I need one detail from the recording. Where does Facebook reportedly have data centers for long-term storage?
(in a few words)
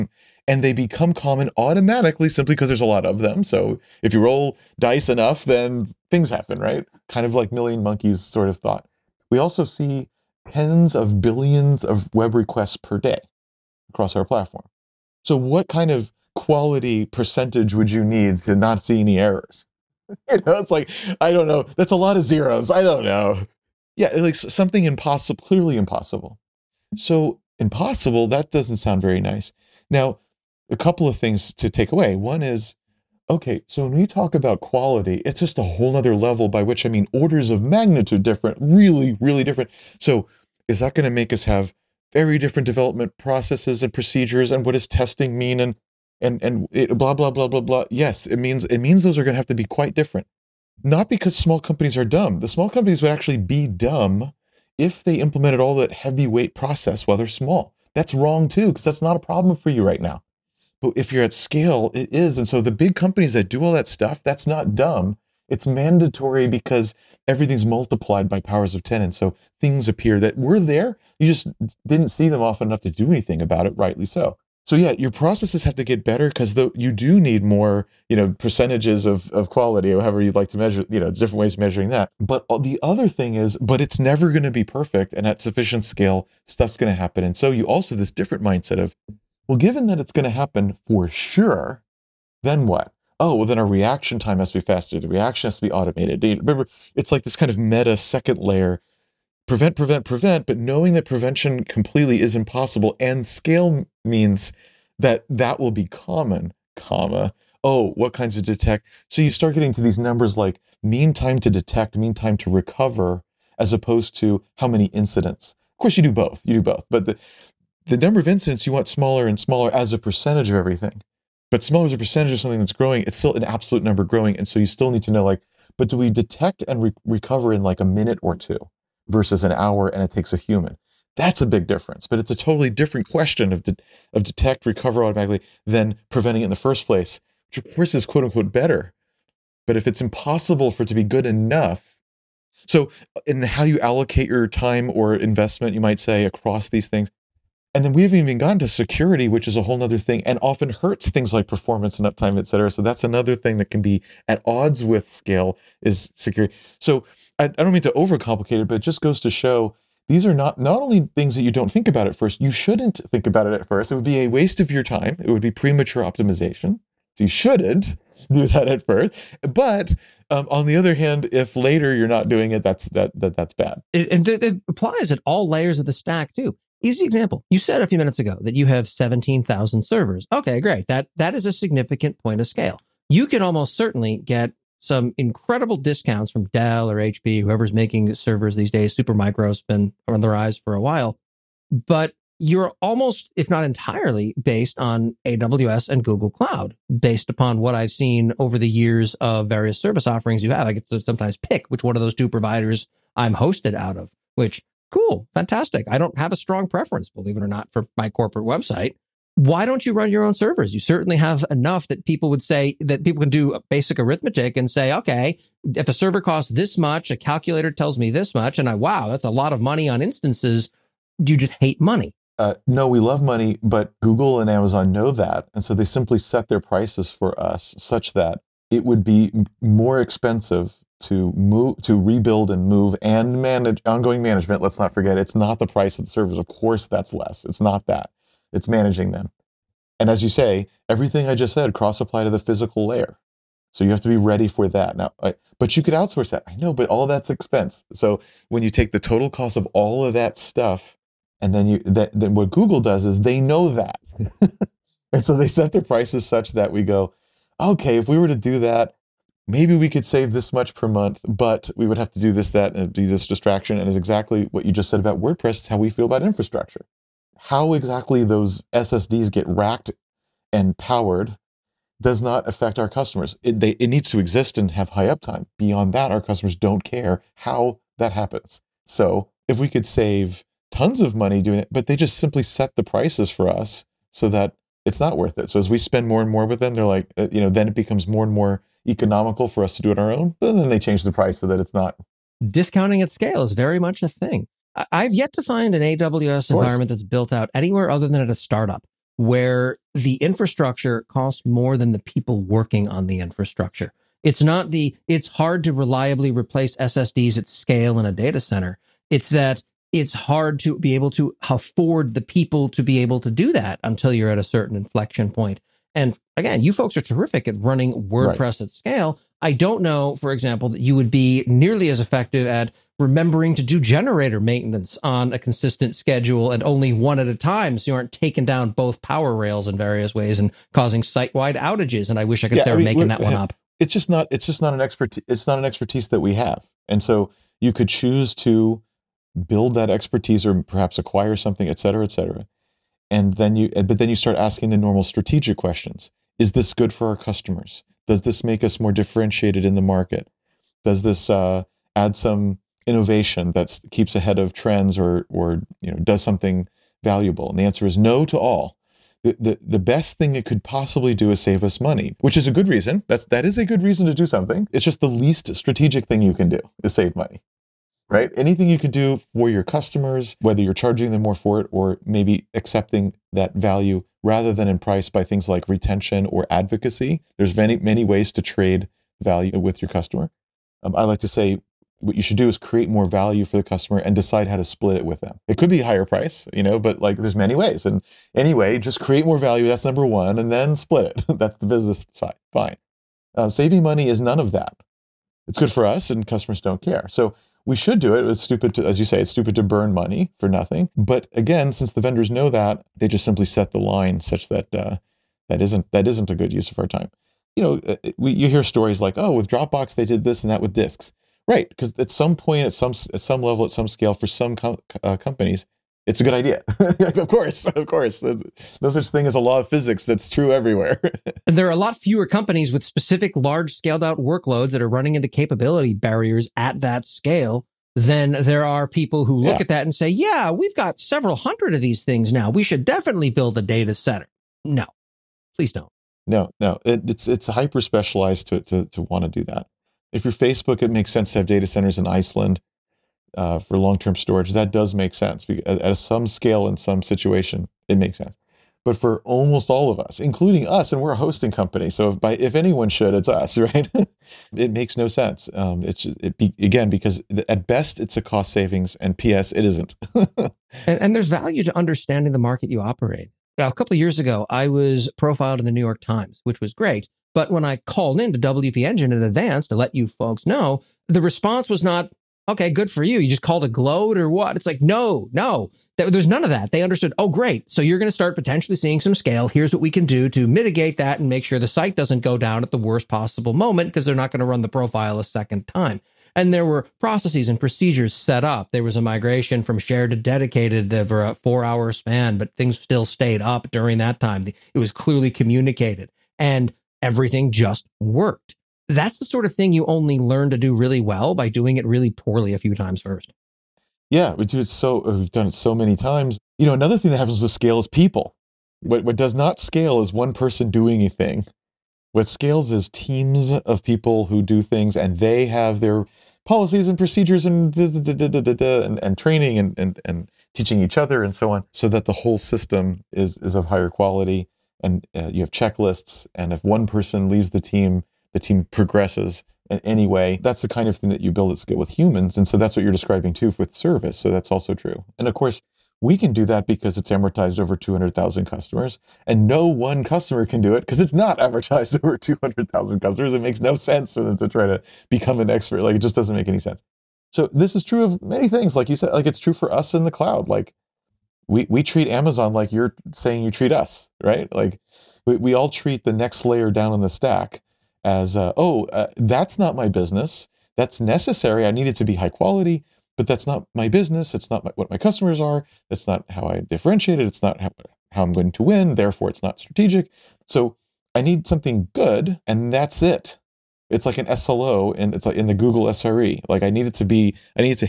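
Iceland.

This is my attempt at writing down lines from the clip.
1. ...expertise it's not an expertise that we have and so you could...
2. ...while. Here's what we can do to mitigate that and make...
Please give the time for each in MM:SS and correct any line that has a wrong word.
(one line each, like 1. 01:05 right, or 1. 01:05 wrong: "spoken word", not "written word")
1. 05:34 right
2. 07:59 wrong: "scale", not "while".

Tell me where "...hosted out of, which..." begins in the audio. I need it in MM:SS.
03:23.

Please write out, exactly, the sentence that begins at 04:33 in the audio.
It, they, it needs to exist and have high uptime.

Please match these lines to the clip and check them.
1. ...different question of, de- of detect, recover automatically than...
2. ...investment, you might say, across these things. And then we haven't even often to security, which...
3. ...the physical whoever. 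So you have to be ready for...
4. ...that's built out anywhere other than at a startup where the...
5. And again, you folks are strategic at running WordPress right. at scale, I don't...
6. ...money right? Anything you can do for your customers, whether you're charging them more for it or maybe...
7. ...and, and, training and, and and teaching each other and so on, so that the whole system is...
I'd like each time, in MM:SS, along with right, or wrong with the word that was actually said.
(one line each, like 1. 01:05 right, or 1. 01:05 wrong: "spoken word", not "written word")
1. 02:12 right
2. 02:25 wrong: "gotten", not "often"
3. 04:02 wrong: "layer", not "whoever"
4. 04:56 right
5. 05:15 wrong: "terrific", not "strategic"
6. 06:07 right
7. 08:37 right.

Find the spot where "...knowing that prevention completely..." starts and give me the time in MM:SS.
01:40.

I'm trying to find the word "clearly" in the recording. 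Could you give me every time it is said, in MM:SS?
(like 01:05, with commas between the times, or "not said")
00:25, 08:14.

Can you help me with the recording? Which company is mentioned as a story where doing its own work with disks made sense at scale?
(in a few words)
Dropbox.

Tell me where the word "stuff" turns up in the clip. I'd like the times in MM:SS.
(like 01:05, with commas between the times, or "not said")
01:03, 01:26, 04:10.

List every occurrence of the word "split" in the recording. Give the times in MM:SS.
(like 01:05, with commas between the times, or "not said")
06:24, 06:30.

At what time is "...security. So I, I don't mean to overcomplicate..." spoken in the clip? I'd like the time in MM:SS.
02:36.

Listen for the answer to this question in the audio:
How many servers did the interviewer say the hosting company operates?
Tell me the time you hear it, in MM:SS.
02:58.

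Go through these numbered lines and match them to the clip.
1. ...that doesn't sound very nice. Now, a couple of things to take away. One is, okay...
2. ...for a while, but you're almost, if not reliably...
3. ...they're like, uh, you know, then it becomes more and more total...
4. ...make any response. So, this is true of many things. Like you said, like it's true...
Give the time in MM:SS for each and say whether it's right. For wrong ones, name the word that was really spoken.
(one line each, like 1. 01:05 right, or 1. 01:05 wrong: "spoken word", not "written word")
1. 00:28 right
2. 03:10 wrong: "entirely", not "reliably"
3. 04:46 wrong: "economical", not "total"
4. 09:06 wrong: "sense", not "response".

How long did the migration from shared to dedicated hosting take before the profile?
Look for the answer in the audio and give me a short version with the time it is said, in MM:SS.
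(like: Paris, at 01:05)
4 hours, at 08:11.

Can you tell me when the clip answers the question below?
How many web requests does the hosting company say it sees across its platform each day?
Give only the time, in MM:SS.
00:10.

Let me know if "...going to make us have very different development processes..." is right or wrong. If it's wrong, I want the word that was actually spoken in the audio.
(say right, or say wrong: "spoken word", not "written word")
right.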